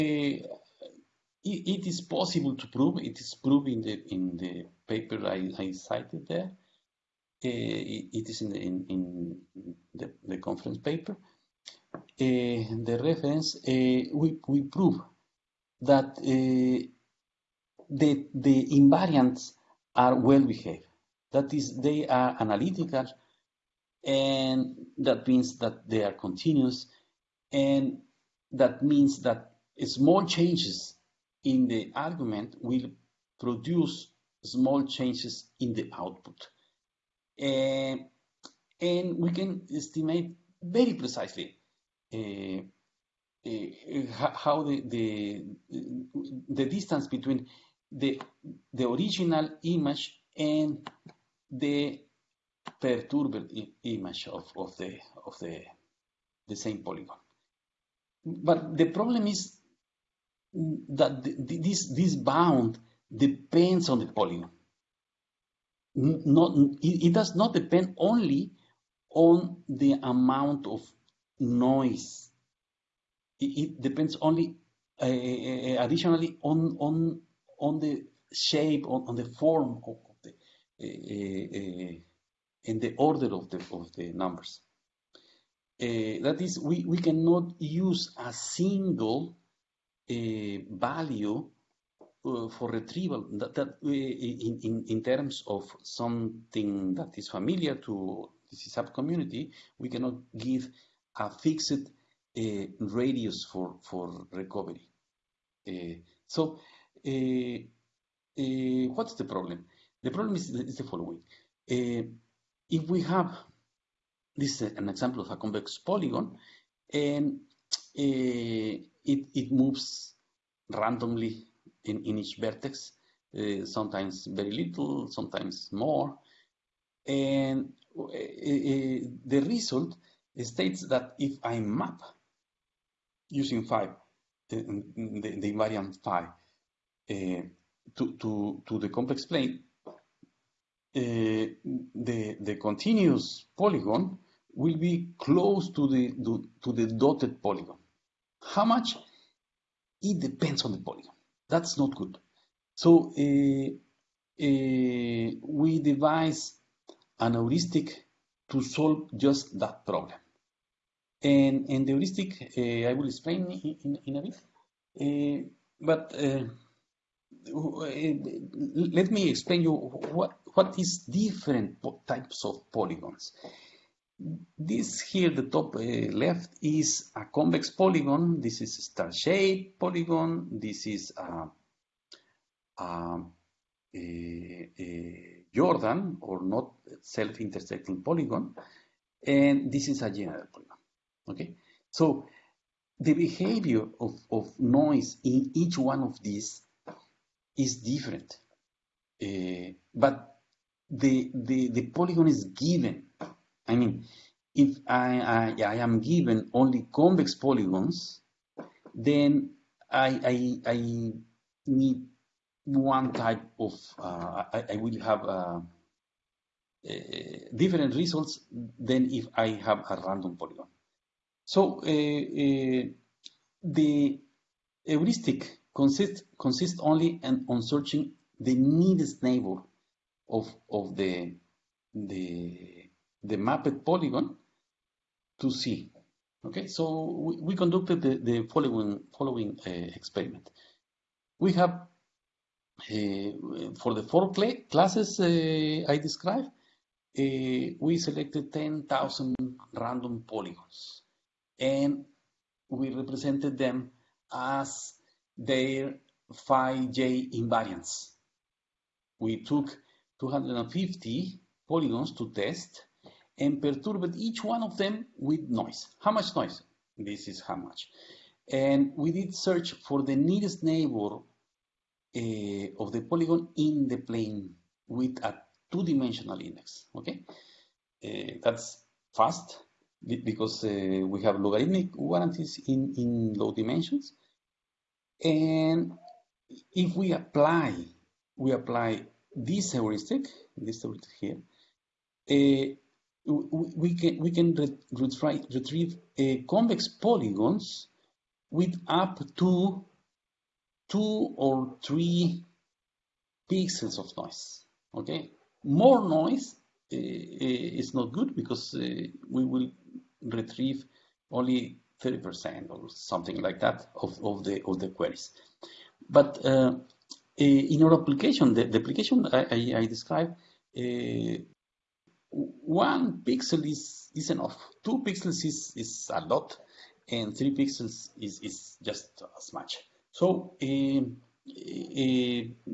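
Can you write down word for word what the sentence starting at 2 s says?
It is proved in the in the paper I, I cited there.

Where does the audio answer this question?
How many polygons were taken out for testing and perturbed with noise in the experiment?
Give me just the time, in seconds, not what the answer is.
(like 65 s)
260 s.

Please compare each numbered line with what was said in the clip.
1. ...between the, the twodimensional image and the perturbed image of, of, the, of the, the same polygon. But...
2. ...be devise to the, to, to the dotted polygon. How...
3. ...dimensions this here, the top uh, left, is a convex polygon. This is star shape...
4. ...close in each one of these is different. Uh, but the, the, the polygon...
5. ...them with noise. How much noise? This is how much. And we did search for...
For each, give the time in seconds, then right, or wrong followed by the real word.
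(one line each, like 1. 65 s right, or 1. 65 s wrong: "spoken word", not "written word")
1. 47 s wrong: "original", not "twodimensional"
2. 144 s wrong: "close", not "devise"
3. 172 s wrong: "polygons", not "dimensions"
4. 194 s wrong: "noise", not "close"
5. 264 s right.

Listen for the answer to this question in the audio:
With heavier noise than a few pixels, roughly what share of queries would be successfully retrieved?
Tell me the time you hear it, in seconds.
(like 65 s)
312 s.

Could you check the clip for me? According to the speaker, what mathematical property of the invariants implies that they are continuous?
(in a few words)
Analytical.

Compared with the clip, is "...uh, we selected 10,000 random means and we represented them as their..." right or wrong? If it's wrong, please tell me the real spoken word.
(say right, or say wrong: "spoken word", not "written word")
wrong: "polygons", not "means".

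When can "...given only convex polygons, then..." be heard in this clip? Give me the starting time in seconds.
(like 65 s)
206 s.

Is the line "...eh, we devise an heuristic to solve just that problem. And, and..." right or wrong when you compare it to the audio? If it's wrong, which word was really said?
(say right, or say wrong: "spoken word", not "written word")
right.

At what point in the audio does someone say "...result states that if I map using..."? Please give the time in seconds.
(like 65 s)
129 s.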